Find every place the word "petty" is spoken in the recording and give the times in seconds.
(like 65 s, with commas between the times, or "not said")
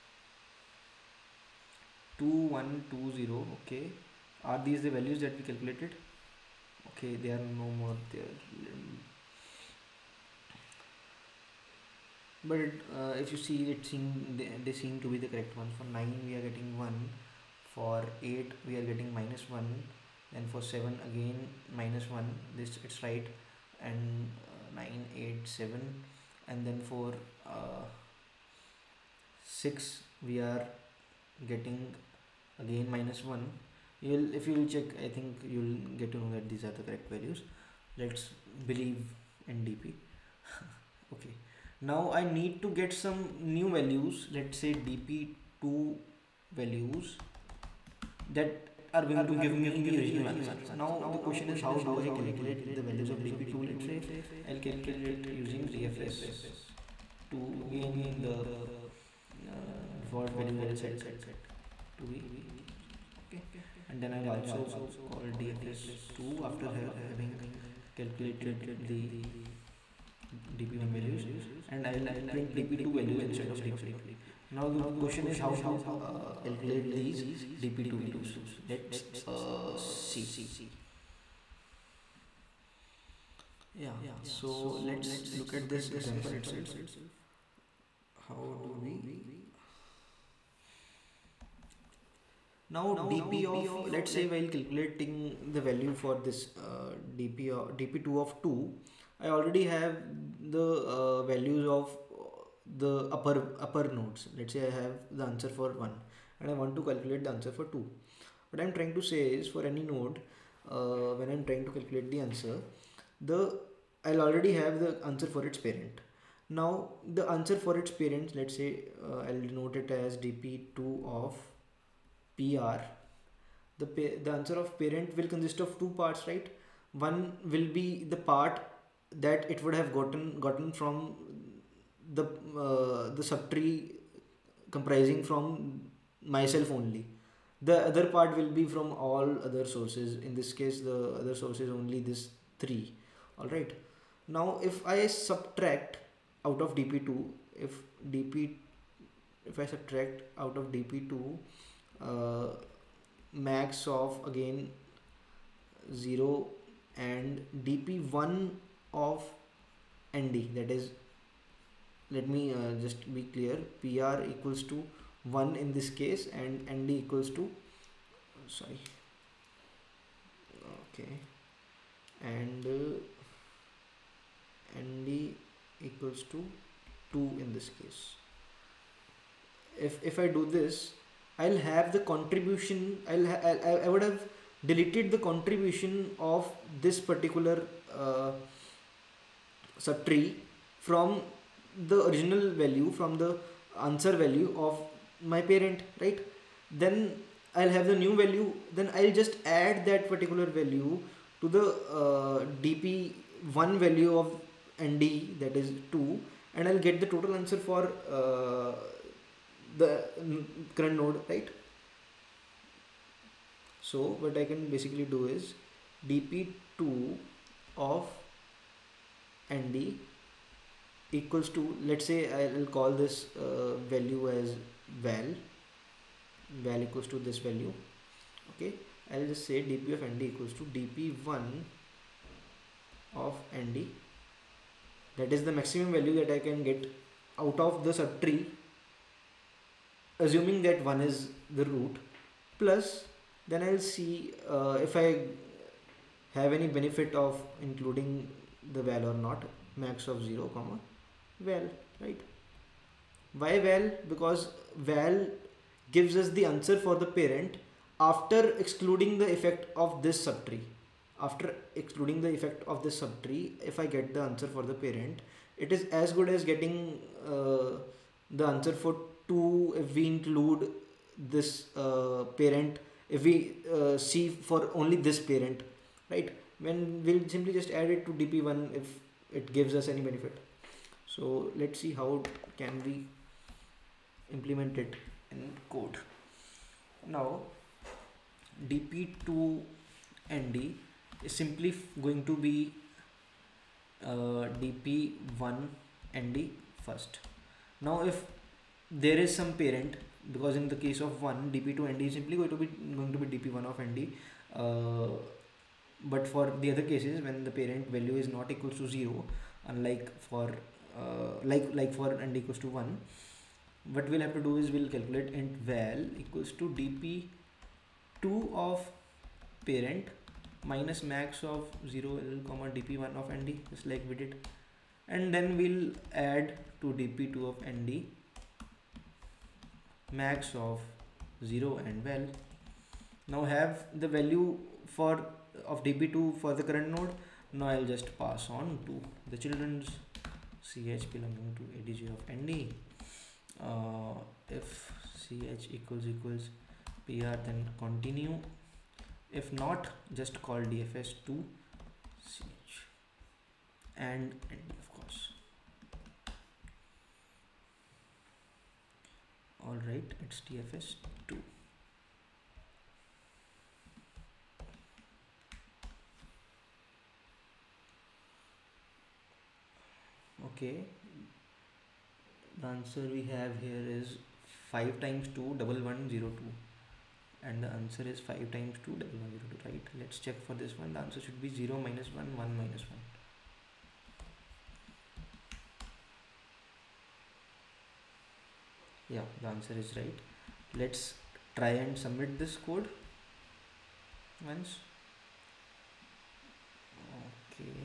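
not said.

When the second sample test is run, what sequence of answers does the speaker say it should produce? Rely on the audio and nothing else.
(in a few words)
0 -1 1 -1.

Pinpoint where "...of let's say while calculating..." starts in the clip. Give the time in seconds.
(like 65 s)
93 s.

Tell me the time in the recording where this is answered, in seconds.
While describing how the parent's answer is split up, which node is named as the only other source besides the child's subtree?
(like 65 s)
140 s.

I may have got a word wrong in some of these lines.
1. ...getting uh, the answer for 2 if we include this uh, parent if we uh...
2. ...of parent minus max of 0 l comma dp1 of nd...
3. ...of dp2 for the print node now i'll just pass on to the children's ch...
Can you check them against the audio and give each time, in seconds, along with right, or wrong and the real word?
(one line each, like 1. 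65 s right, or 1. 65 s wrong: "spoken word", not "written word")
1. 266 s right
2. 318 s right
3. 335 s wrong: "current", not "print".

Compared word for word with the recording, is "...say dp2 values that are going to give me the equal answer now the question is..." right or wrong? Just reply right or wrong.
wrong.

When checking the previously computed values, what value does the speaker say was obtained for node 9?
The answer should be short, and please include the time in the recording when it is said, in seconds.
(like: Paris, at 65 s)
1, at 15 s.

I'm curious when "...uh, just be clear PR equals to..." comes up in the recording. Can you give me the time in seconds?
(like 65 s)
162 s.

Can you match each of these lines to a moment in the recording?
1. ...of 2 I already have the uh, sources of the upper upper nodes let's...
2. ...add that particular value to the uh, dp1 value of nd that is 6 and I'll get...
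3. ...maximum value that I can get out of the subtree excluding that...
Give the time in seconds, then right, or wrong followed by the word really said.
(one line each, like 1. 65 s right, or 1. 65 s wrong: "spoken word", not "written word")
1. 98 s wrong: "values", not "sources"
2. 199 s wrong: "2", not "6"
3. 235 s wrong: "assuming", not "excluding".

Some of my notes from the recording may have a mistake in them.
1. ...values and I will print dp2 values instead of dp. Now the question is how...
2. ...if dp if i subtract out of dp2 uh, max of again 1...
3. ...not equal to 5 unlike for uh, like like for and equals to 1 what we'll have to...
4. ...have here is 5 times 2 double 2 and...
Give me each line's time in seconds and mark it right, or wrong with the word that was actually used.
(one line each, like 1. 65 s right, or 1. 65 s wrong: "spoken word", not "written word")
1. 70 s right
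2. 147 s wrong: "0", not "1"
3. 308 s wrong: "0", not "5"
4. 373 s right.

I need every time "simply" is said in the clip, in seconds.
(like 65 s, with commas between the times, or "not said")
277 s, 291 s, 302 s.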